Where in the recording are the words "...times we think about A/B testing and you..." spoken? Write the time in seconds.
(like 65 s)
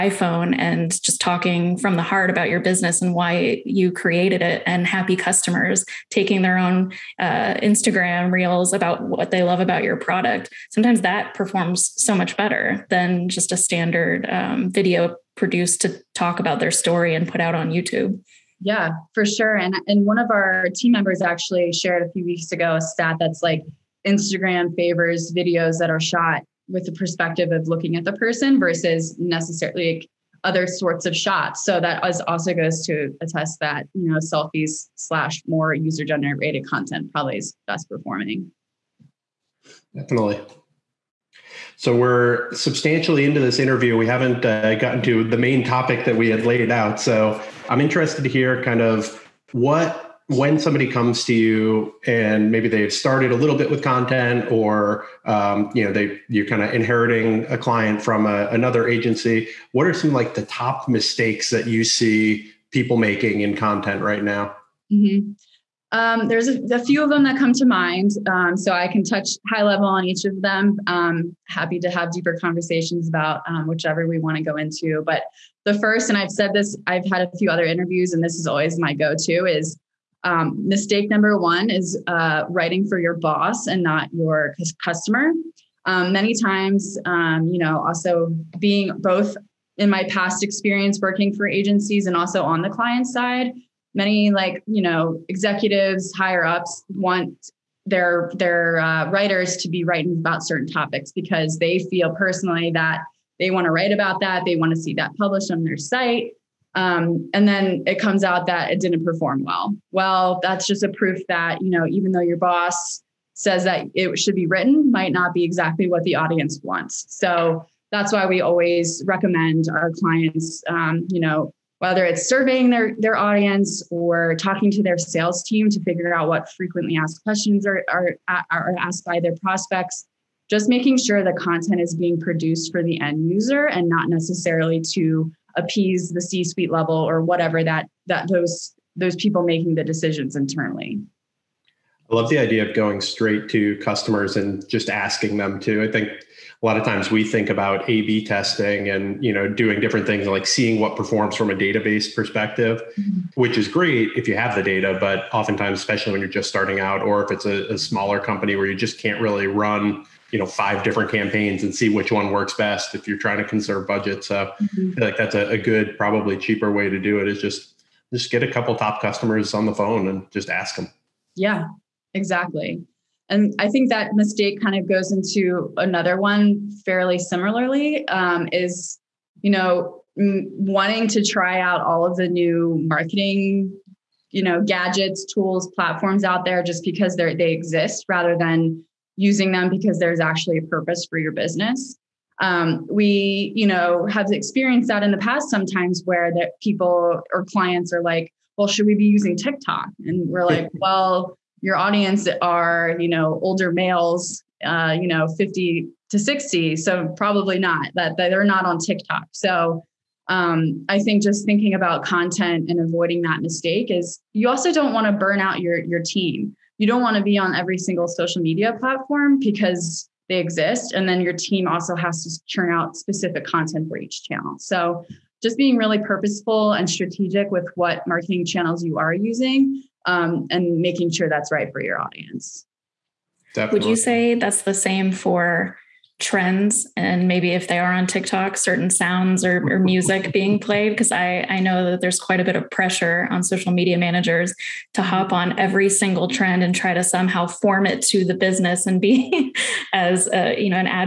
146 s.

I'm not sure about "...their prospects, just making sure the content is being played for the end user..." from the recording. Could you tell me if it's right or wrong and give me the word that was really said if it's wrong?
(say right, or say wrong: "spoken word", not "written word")
wrong: "produced", not "played".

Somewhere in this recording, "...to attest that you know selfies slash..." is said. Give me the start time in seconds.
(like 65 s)
32 s.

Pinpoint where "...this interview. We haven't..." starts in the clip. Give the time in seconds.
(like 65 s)
43 s.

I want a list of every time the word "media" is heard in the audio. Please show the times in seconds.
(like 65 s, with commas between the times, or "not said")
218 s, 243 s.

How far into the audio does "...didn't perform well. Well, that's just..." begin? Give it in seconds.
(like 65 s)
108 s.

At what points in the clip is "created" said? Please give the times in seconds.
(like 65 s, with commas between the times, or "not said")
3 s.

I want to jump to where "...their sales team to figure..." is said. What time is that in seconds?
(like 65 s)
124 s.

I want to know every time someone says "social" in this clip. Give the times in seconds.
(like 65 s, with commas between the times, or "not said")
218 s, 243 s.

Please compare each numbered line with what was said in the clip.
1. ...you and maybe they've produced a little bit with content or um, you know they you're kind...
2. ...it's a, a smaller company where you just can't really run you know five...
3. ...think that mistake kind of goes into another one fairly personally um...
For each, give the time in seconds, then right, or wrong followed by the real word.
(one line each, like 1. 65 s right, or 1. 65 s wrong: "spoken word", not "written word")
1. 51 s wrong: "started", not "produced"
2. 157 s right
3. 173 s wrong: "similarly", not "personally".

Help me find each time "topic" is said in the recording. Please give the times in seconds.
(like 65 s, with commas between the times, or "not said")
45 s, 100 s.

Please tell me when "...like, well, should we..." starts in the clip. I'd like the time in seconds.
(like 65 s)
198 s.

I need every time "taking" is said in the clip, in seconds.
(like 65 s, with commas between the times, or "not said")
6 s.